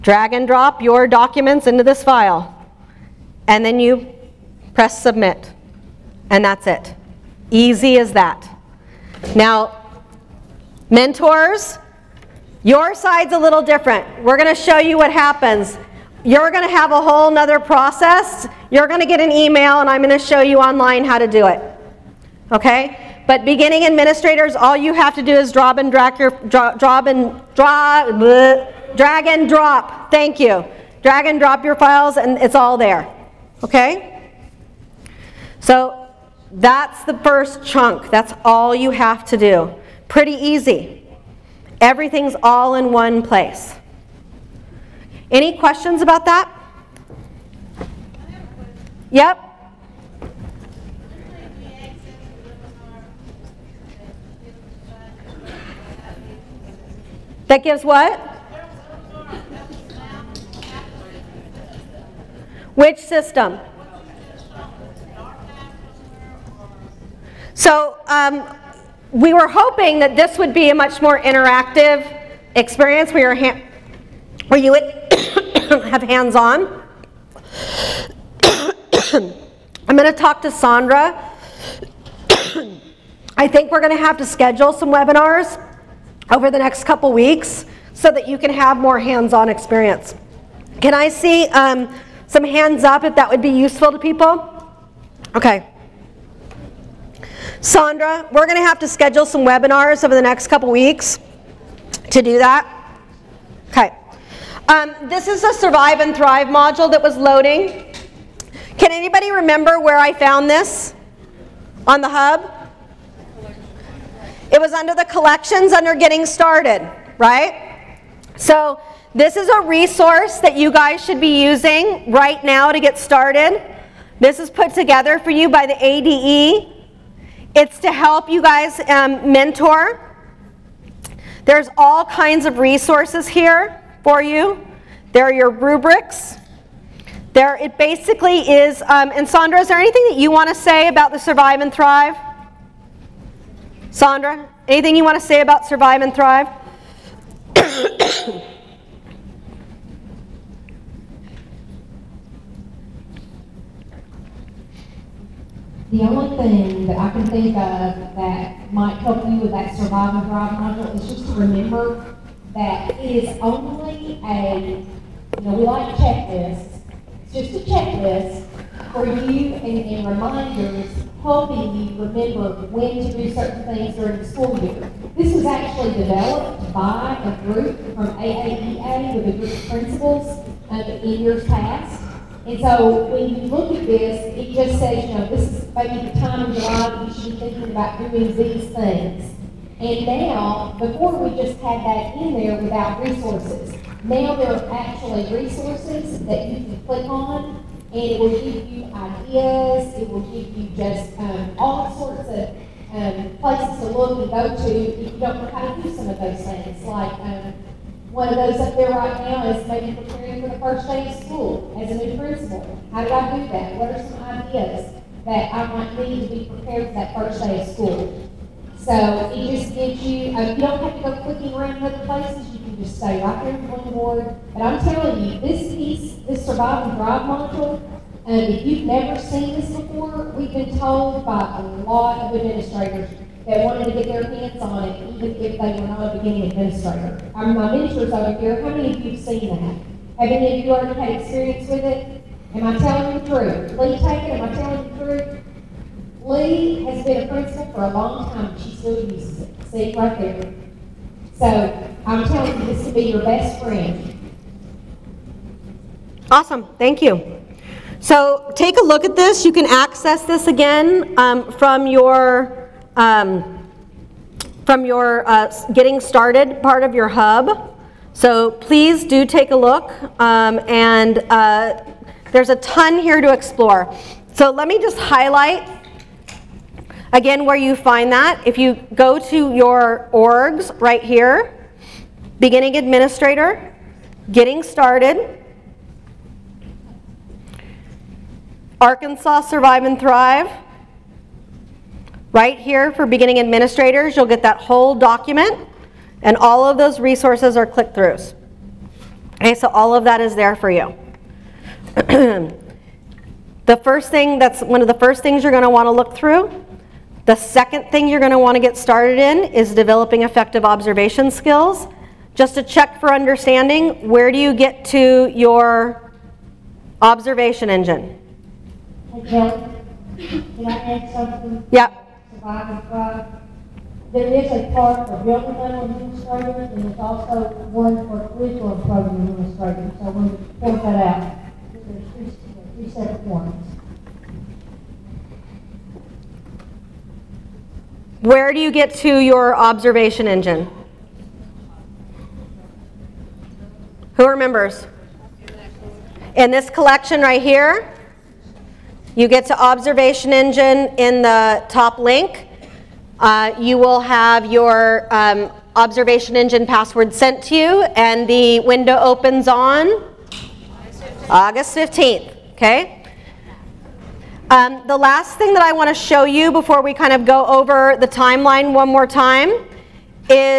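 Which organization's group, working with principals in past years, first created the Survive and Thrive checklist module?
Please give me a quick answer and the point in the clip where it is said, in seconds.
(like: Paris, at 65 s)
AAEA, at 178 s.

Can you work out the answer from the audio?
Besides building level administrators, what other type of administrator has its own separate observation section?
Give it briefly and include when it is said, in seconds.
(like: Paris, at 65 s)
curriculum program administrators, at 328 s.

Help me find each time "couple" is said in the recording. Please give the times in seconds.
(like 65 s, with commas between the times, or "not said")
86 s, 100 s.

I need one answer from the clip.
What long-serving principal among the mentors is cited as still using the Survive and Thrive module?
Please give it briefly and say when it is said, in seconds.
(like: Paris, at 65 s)
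Lee Taken, at 243 s.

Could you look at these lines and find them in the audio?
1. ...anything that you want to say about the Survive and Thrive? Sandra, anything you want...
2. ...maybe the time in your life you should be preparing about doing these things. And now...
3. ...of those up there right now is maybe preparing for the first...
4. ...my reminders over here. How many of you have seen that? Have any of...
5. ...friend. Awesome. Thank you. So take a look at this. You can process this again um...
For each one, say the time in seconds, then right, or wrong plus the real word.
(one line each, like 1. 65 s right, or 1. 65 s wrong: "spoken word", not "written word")
1. 139 s right
2. 185 s wrong: "thinking", not "preparing"
3. 208 s right
4. 237 s wrong: "mentors", not "reminders"
5. 253 s wrong: "access", not "process".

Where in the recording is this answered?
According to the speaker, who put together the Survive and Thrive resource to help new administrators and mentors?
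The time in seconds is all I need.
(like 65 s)
125 s.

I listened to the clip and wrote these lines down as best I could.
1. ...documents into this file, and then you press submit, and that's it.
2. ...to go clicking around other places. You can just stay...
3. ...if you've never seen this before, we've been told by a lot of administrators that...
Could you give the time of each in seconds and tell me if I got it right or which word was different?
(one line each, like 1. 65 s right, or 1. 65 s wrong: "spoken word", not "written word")
1. 1 s right
2. 220 s right
3. 228 s right.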